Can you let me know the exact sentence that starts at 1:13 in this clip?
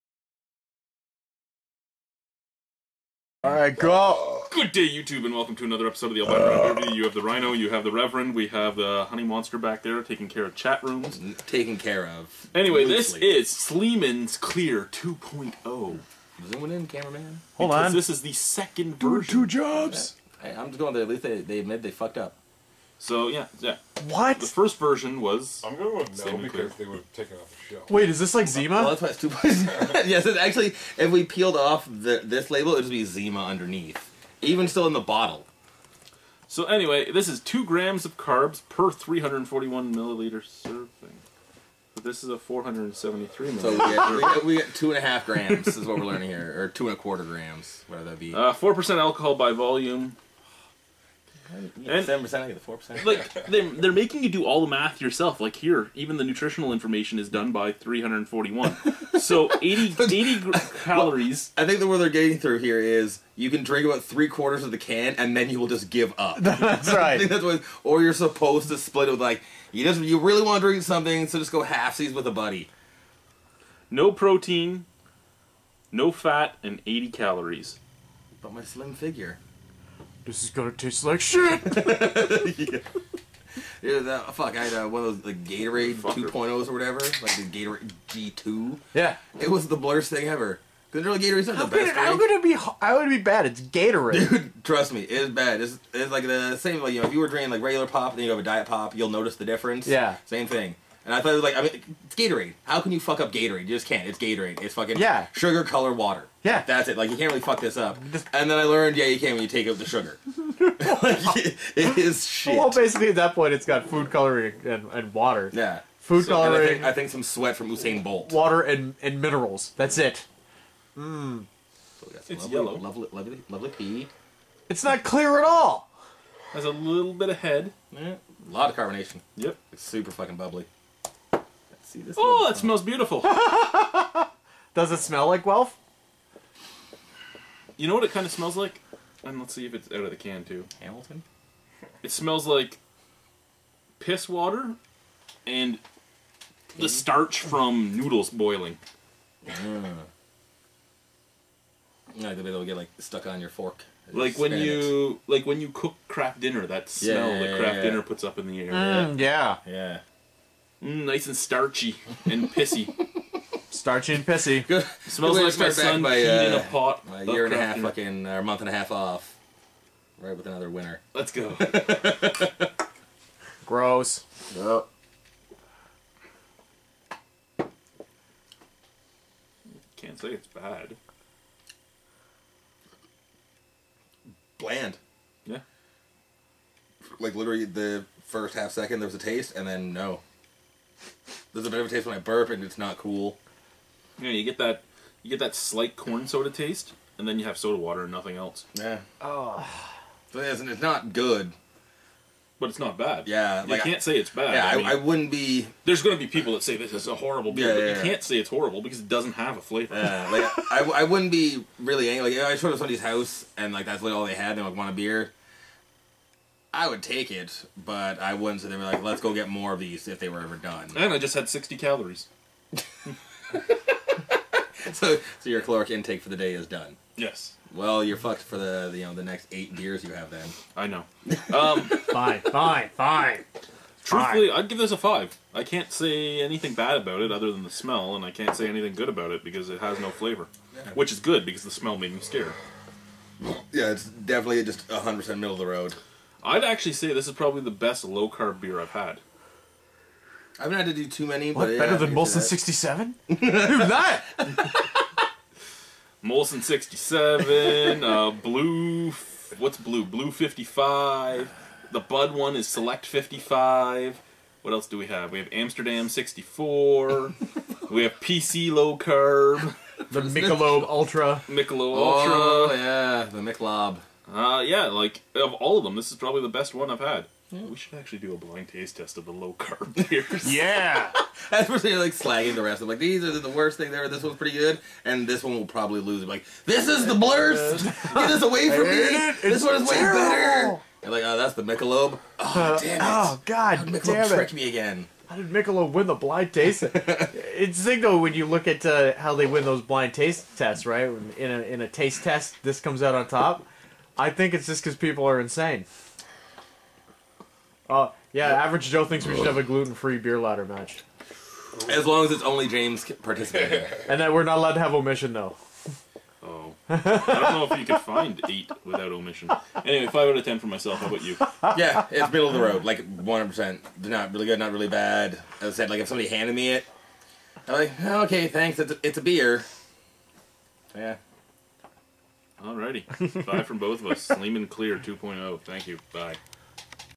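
No protein, no fat, and 80 calories.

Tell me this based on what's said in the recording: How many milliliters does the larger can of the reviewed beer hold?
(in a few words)
473 milliliters.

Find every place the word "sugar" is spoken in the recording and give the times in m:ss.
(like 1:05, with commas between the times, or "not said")
1:45, 1:49.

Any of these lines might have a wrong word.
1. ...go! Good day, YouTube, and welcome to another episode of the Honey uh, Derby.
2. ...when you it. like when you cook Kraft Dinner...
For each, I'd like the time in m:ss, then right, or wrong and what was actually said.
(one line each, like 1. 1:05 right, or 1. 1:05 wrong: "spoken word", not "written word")
1. 0:03 wrong: "Alberta", not "Honey"
2. 2:34 right.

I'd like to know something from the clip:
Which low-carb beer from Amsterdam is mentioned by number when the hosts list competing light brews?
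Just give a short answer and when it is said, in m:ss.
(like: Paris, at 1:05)
Amsterdam 64, at 4:25.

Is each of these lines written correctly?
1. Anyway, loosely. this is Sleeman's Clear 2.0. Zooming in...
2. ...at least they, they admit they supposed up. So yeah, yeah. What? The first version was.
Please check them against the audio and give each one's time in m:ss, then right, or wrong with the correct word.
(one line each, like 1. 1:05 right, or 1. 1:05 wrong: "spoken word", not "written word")
1. 0:12 right
2. 0:21 wrong: "fucked", not "supposed".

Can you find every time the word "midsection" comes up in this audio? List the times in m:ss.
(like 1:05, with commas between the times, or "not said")
not said.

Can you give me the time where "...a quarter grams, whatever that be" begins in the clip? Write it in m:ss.
0:46.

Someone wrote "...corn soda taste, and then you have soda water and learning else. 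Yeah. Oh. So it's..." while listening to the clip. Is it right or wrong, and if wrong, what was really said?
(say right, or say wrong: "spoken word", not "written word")
wrong: "nothing", not "learning".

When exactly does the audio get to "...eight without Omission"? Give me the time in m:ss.
5:18.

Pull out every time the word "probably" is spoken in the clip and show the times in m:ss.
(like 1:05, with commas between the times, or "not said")
4:07, 4:36, 4:45.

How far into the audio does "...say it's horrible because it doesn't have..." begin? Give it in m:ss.
3:28.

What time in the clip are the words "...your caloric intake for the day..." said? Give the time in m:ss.
3:45.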